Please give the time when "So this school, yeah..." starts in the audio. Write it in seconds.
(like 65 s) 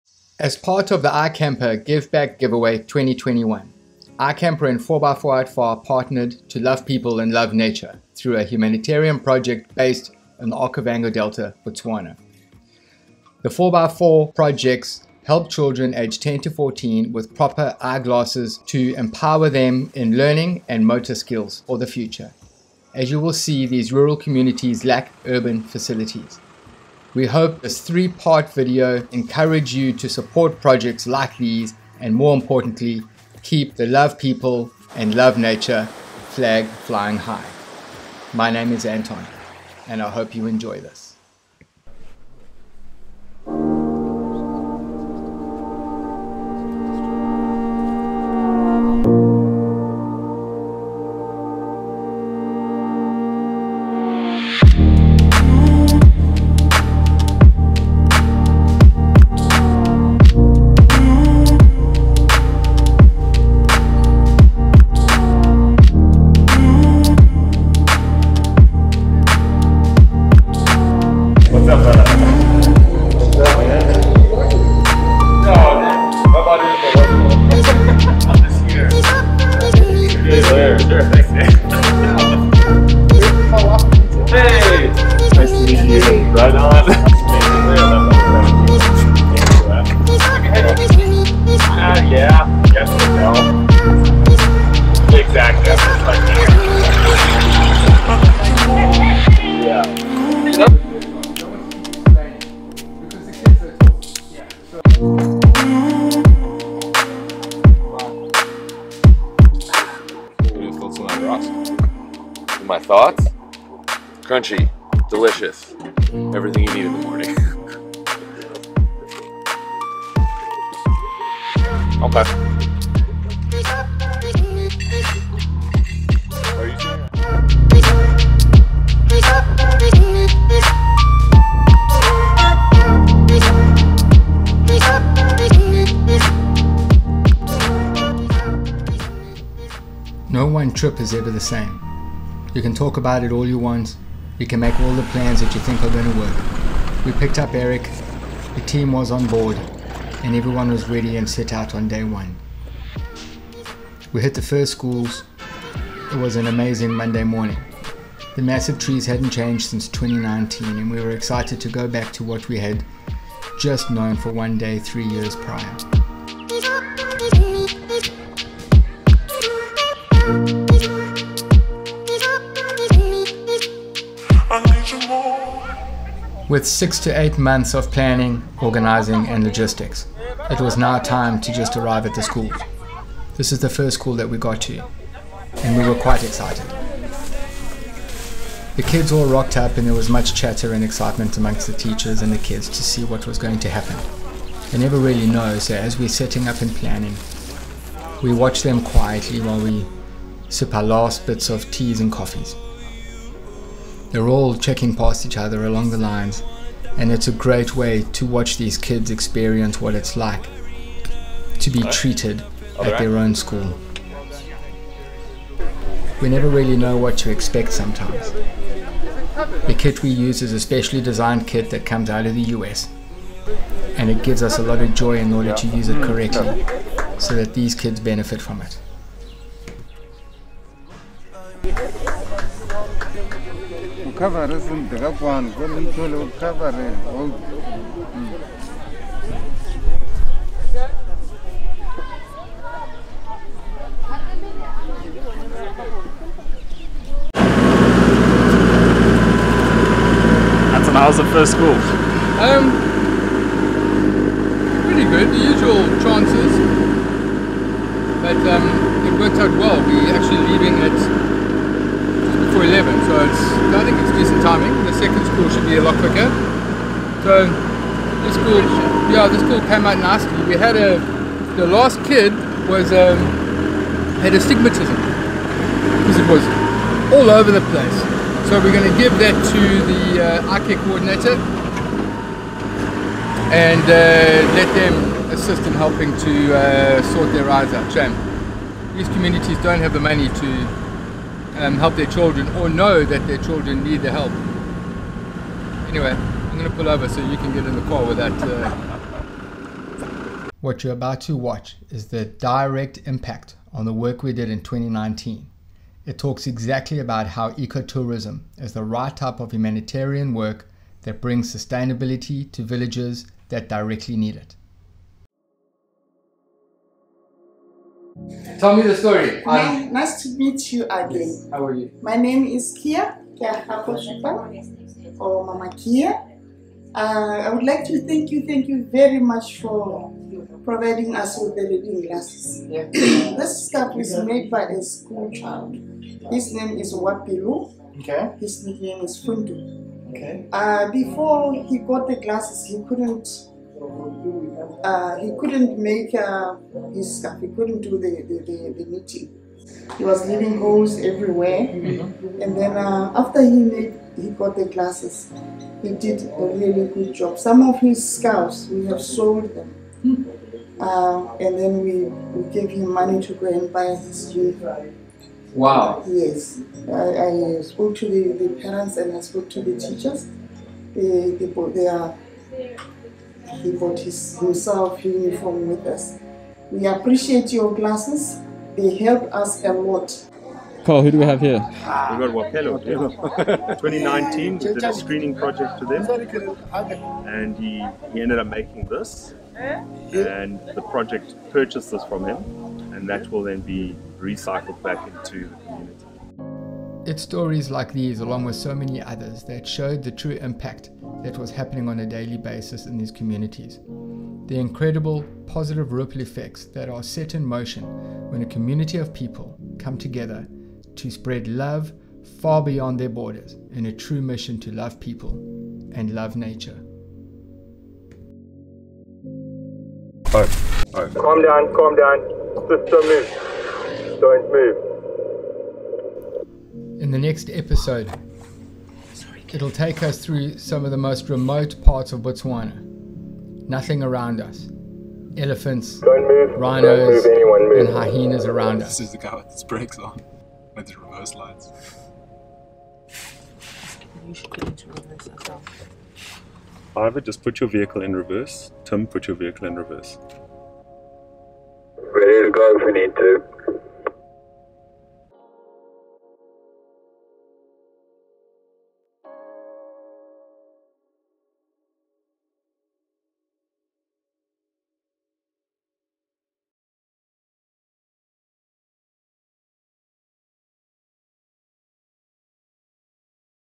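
267 s.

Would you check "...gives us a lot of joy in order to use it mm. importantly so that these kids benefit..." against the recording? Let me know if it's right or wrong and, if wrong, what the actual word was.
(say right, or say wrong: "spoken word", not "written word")
wrong: "correctly", not "importantly".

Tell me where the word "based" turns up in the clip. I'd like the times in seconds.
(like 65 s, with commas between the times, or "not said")
9 s.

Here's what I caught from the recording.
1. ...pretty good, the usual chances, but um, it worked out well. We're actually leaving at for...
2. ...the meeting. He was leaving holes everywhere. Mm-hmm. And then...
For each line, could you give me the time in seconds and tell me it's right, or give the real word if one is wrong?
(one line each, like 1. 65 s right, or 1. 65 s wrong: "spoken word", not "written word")
1. 254 s right
2. 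348 s right.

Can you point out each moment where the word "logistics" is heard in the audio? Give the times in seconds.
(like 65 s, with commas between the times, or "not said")
179 s.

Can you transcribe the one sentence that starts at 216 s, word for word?
We never really know what to expect sometimes.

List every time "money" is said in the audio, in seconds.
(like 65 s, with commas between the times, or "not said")
290 s, 362 s.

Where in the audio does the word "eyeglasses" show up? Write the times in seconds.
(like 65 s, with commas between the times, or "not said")
17 s.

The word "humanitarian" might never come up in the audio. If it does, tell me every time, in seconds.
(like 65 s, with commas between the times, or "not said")
8 s, 309 s.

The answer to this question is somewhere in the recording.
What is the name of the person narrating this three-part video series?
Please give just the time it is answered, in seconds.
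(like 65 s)
38 s.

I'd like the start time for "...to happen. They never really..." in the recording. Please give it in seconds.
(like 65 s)
193 s.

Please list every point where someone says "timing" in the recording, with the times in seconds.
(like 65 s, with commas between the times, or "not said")
264 s.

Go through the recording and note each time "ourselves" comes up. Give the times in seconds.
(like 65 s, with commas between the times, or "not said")
445 s.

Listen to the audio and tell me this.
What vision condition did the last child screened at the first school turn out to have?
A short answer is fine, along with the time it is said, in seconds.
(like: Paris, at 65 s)
Astigmatism, at 274 s.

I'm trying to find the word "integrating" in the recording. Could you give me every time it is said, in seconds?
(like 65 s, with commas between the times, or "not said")
not said.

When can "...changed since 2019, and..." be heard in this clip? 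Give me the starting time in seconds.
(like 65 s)
159 s.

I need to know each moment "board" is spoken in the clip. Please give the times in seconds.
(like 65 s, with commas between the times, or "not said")
149 s.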